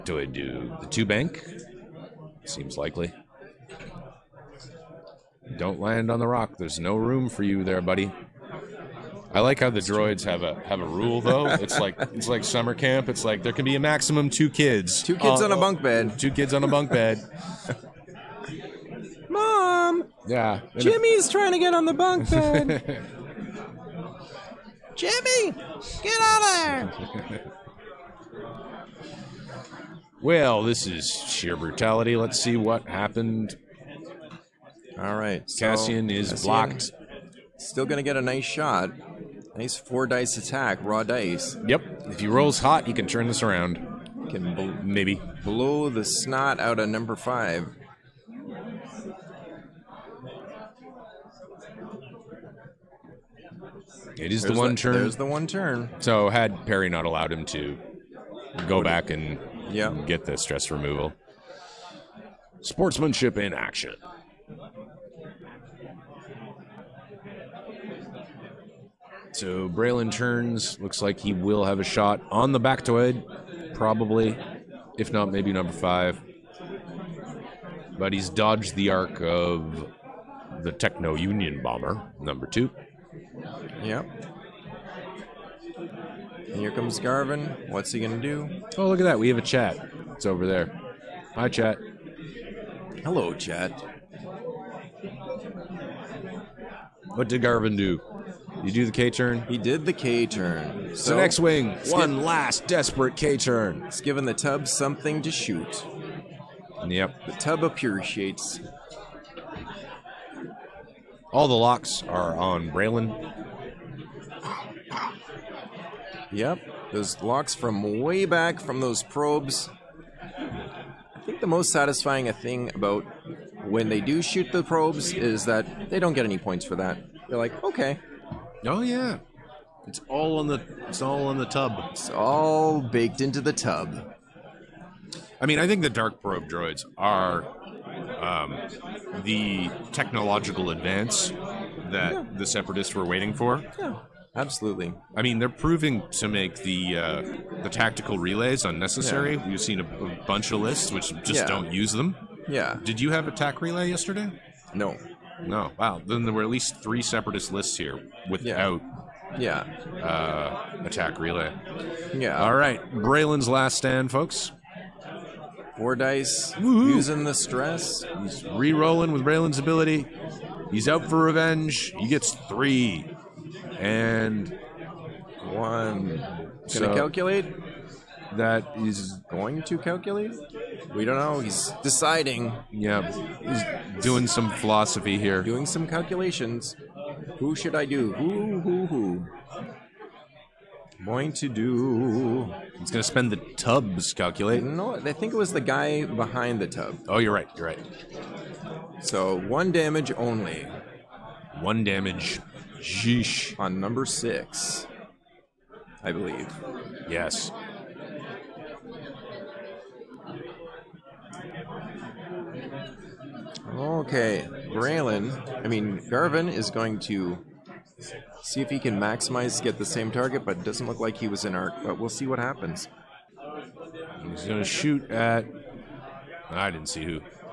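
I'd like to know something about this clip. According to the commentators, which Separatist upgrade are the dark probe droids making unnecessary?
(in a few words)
tactical relays.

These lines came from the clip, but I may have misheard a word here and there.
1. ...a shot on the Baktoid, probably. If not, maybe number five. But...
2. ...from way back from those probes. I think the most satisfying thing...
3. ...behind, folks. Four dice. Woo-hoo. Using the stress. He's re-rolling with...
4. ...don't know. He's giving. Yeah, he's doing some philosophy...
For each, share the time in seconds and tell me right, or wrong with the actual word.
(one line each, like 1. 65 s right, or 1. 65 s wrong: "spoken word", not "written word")
1. 71 s right
2. 117 s right
3. 163 s wrong: "stand", not "behind"
4. 181 s wrong: "deciding", not "giving".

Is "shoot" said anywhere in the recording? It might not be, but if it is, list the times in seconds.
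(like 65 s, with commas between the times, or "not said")
105 s, 124 s, 224 s.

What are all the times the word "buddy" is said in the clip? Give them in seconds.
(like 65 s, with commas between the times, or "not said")
7 s.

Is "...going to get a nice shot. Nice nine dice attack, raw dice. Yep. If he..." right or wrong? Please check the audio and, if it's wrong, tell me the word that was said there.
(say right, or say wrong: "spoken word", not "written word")
wrong: "four", not "nine".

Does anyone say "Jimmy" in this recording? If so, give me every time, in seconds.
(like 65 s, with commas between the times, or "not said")
20 s, 24 s.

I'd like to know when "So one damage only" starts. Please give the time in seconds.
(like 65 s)
199 s.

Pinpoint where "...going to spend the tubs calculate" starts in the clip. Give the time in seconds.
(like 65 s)
192 s.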